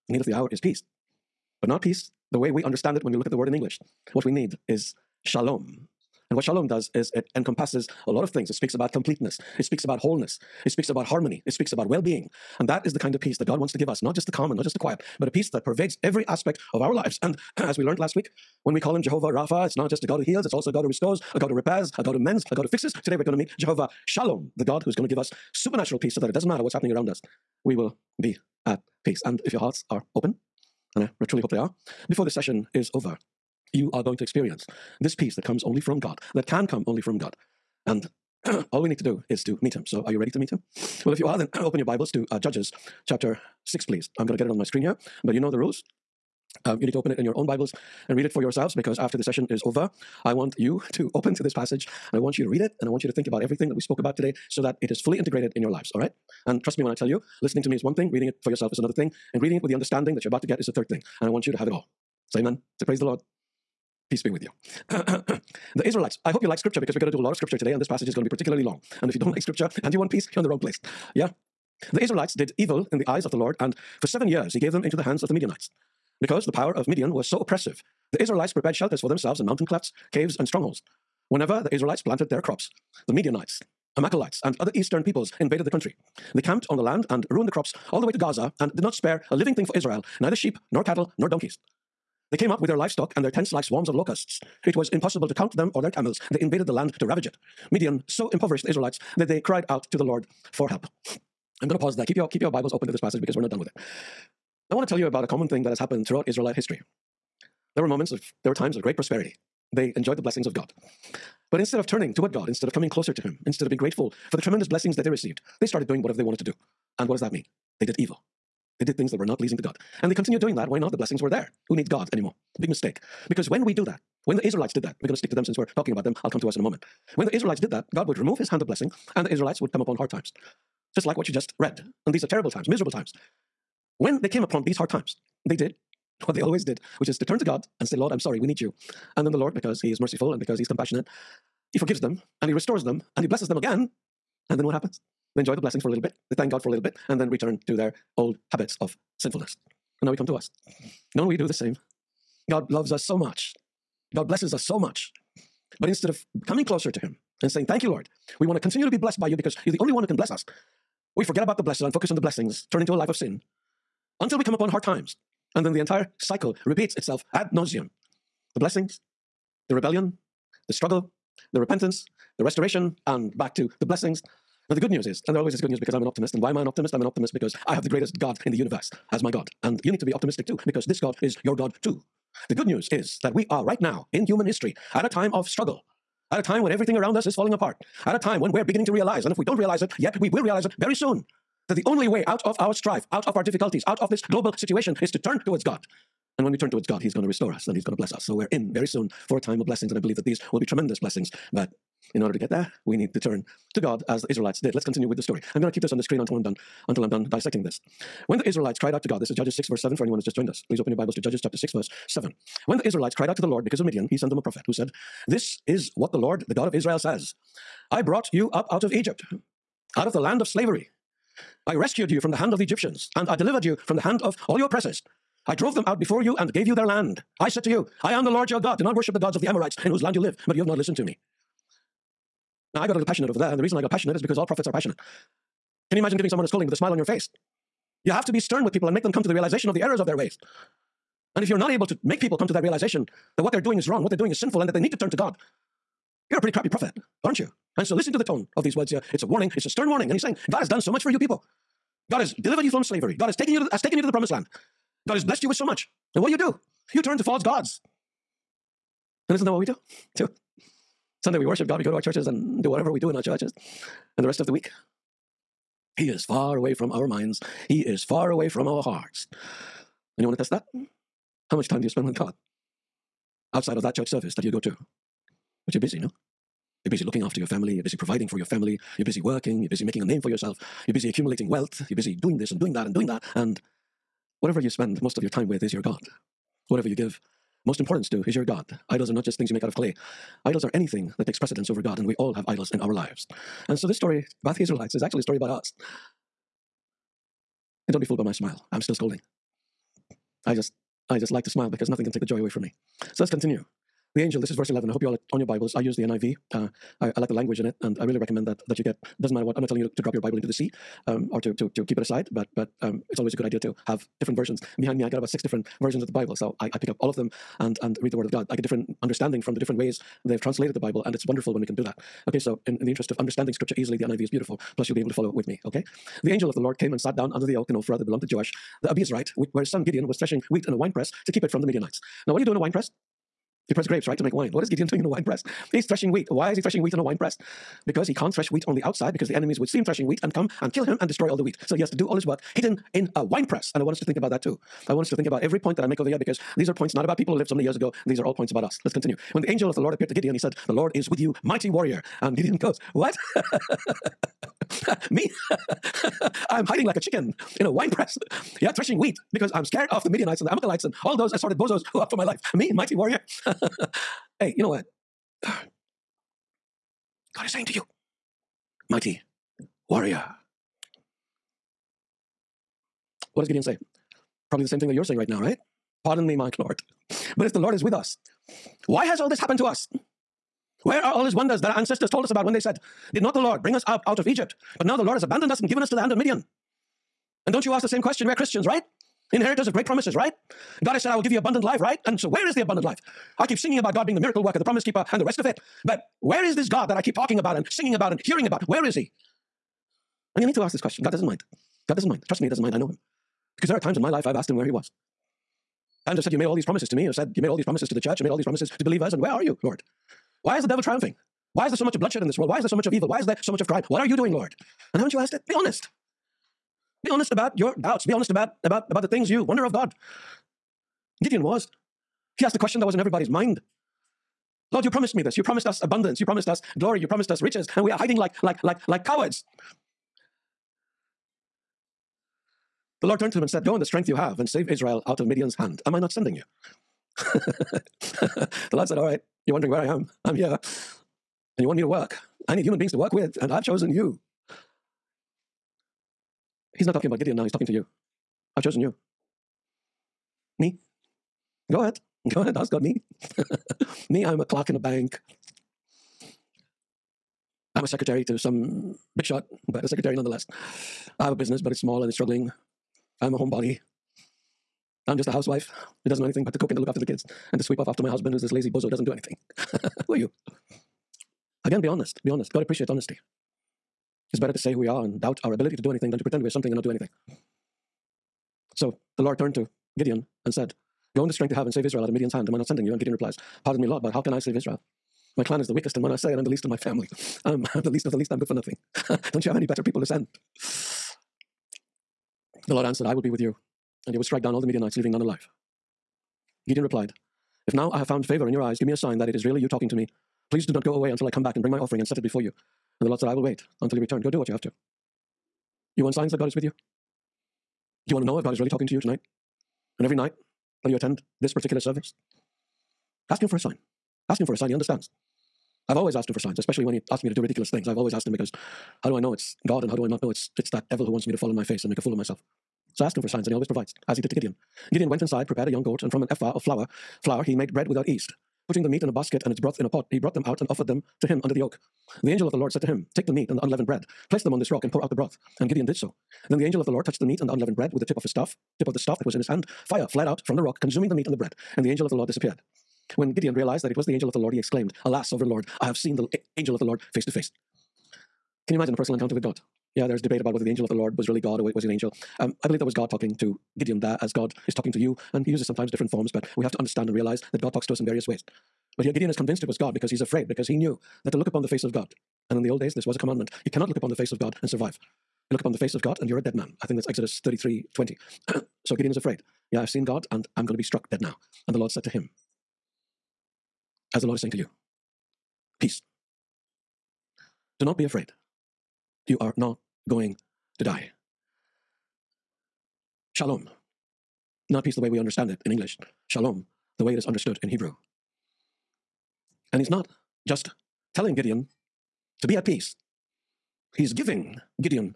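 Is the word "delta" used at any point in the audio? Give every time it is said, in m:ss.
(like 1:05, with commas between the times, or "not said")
not said.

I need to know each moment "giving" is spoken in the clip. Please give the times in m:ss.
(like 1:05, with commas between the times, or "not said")
3:56, 9:54.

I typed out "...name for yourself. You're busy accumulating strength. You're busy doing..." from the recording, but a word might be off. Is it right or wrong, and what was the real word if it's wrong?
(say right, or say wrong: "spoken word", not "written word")
wrong: "wealth", not "strength".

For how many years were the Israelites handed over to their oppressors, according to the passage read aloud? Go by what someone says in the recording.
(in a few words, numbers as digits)
7.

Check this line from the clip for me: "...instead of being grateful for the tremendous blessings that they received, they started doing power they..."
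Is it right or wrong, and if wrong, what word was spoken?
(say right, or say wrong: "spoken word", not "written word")
wrong: "whatever", not "power".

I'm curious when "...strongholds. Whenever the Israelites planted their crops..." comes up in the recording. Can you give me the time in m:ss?
1:20.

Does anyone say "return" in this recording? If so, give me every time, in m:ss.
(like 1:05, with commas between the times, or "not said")
2:27, 8:24.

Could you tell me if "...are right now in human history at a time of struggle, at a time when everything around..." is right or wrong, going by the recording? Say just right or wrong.
right.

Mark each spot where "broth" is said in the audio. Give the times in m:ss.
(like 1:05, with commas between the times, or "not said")
8:49, 8:55.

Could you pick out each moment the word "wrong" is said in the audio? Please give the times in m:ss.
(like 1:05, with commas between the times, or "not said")
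1:10, 4:03.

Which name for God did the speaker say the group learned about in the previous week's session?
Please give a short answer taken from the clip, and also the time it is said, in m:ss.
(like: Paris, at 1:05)
Jehovah Rapha, at 0:19.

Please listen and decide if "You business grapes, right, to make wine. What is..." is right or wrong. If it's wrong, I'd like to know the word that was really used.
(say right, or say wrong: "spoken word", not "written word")
wrong: "press", not "business".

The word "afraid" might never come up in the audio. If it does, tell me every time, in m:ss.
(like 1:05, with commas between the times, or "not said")
9:20, 9:29, 9:38.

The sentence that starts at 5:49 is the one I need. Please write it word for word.
When the angel of the Lord appeared to Gideon, he said, The Lord is with you, mighty warrior.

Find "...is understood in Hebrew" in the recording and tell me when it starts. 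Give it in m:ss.
9:47.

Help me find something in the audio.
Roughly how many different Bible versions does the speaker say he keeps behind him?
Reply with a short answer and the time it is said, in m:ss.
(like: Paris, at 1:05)
6, at 5:15.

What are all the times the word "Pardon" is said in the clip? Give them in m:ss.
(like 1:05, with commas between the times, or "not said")
6:16, 8:03.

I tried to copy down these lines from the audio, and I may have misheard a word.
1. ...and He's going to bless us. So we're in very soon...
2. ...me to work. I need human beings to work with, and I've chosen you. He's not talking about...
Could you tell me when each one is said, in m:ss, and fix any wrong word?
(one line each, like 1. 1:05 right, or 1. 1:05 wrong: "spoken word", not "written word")
1. 3:17 right
2. 7:21 right.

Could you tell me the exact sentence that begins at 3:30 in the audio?
Please open your Bibles to Judges chapter 6, verse 7.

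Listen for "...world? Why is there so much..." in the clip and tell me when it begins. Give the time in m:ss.
6:52.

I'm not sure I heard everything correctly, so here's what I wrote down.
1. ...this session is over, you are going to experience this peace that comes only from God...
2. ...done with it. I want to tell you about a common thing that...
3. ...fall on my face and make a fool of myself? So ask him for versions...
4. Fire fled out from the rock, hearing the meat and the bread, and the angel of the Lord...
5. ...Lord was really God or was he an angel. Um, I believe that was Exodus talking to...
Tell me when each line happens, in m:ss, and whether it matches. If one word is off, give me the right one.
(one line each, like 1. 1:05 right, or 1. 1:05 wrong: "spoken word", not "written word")
1. 0:32 right
2. 1:43 right
3. 8:41 wrong: "signs", not "versions"
4. 8:59 wrong: "consuming", not "hearing"
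5. 9:10 wrong: "God", not "Exodus".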